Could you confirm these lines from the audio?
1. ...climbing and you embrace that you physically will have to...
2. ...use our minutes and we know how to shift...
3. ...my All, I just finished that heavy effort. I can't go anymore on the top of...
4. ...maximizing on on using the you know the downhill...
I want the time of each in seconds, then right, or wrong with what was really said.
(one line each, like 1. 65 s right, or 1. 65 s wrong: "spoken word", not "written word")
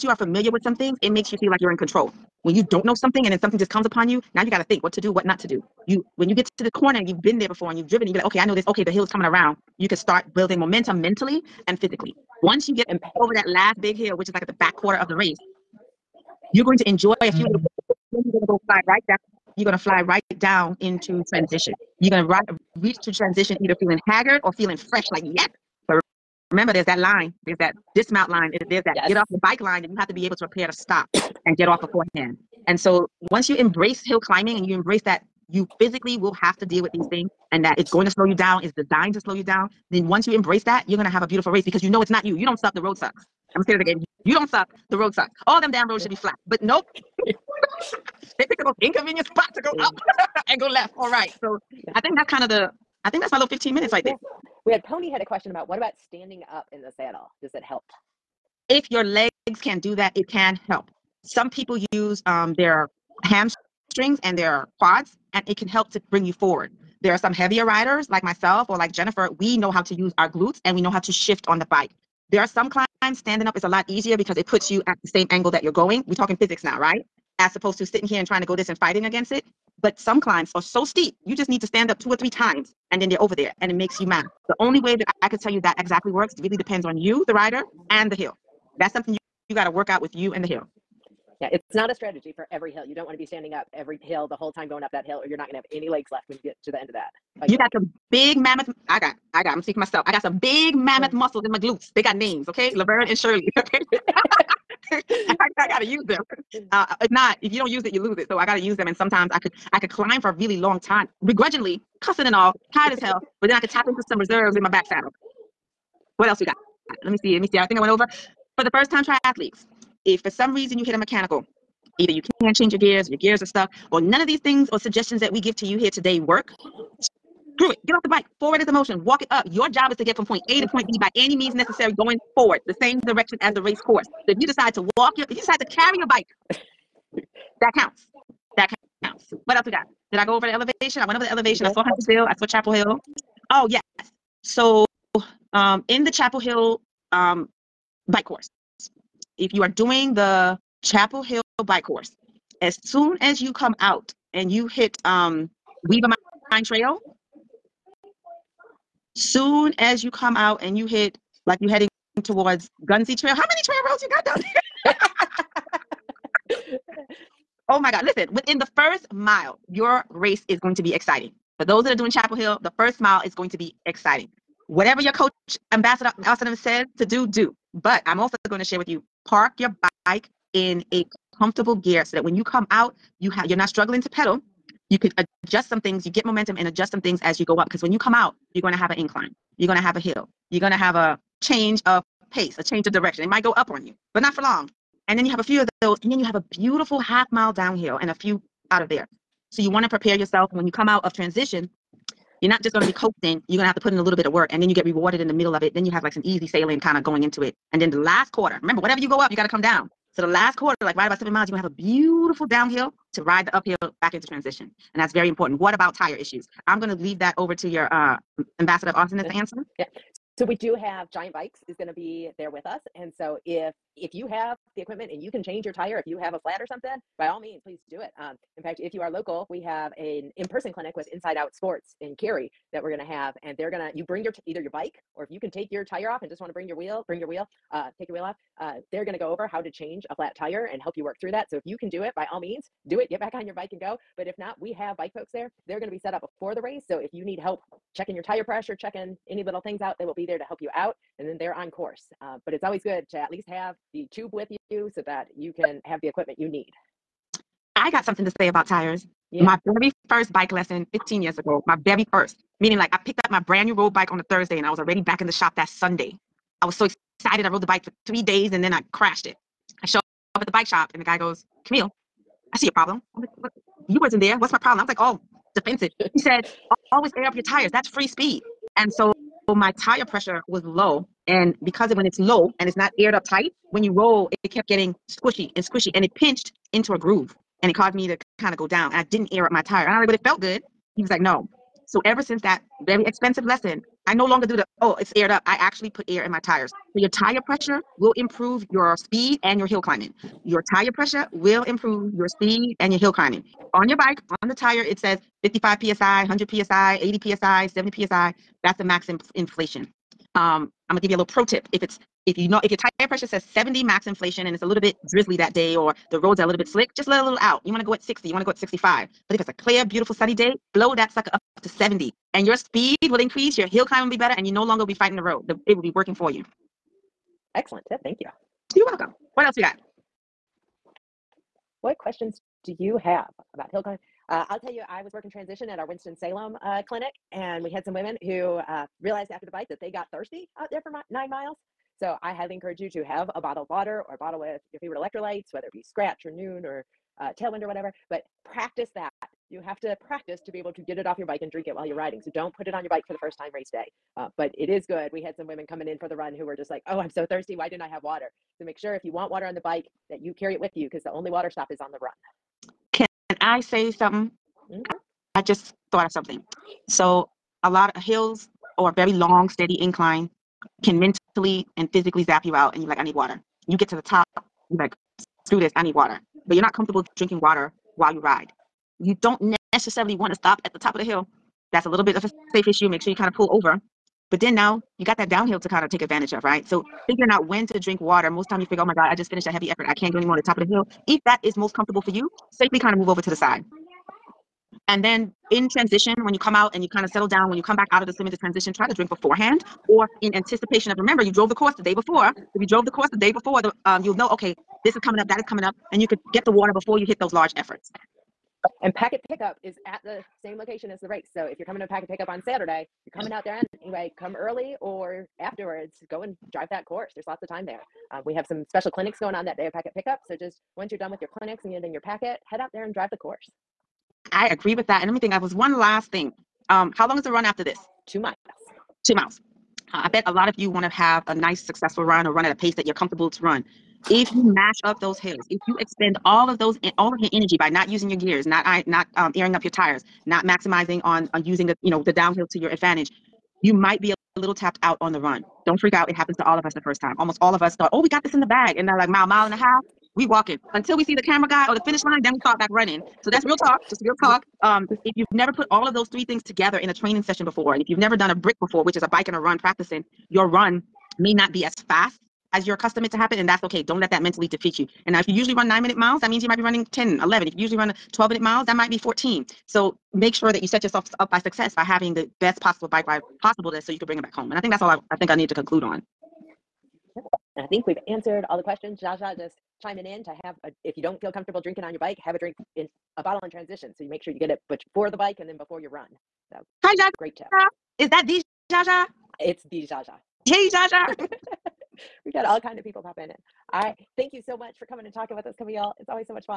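1. 34 s right
2. 69 s wrong: "glutes", not "minutes"
3. 388 s wrong: "God", not "All"
4. 440 s right.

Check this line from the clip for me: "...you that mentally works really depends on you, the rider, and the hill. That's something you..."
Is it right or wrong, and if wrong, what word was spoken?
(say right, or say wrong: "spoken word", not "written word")
wrong: "exactly", not "mentally".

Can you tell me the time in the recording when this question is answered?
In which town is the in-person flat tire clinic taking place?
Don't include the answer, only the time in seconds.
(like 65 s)
232 s.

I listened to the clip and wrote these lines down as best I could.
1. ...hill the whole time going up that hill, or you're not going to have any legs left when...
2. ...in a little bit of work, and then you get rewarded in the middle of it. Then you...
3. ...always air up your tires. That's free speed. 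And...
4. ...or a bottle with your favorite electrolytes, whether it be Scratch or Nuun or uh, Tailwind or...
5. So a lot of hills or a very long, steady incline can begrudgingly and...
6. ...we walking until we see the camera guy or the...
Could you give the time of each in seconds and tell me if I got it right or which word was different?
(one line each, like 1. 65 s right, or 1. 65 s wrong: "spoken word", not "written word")
1. 94 s right
2. 203 s right
3. 276 s right
4. 344 s right
5. 366 s wrong: "mentally", not "begrudgingly"
6. 450 s right.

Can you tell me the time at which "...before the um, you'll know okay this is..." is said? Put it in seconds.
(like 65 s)
403 s.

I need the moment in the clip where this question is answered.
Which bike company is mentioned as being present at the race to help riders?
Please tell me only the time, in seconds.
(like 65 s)
221 s.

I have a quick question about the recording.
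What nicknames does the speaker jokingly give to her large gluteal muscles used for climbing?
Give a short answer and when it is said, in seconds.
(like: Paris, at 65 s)
Laverne and Shirley, at 102 s.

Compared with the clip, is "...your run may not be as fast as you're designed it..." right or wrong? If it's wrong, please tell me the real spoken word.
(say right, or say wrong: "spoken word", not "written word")
wrong: "accustomed", not "designed".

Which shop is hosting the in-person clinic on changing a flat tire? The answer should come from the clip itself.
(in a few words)
Inside Out Sports.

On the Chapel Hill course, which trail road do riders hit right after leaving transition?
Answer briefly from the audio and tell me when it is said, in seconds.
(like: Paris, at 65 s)
Weaver Mine Trail, at 155 s.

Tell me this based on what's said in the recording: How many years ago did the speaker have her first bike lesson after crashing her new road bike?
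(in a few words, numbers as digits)
15.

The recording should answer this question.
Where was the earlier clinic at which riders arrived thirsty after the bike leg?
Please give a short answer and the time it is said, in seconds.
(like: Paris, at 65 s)
Winston-Salem, at 335 s.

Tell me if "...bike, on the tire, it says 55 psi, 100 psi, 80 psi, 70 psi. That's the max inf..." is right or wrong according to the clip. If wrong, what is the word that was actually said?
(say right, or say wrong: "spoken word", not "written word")
right.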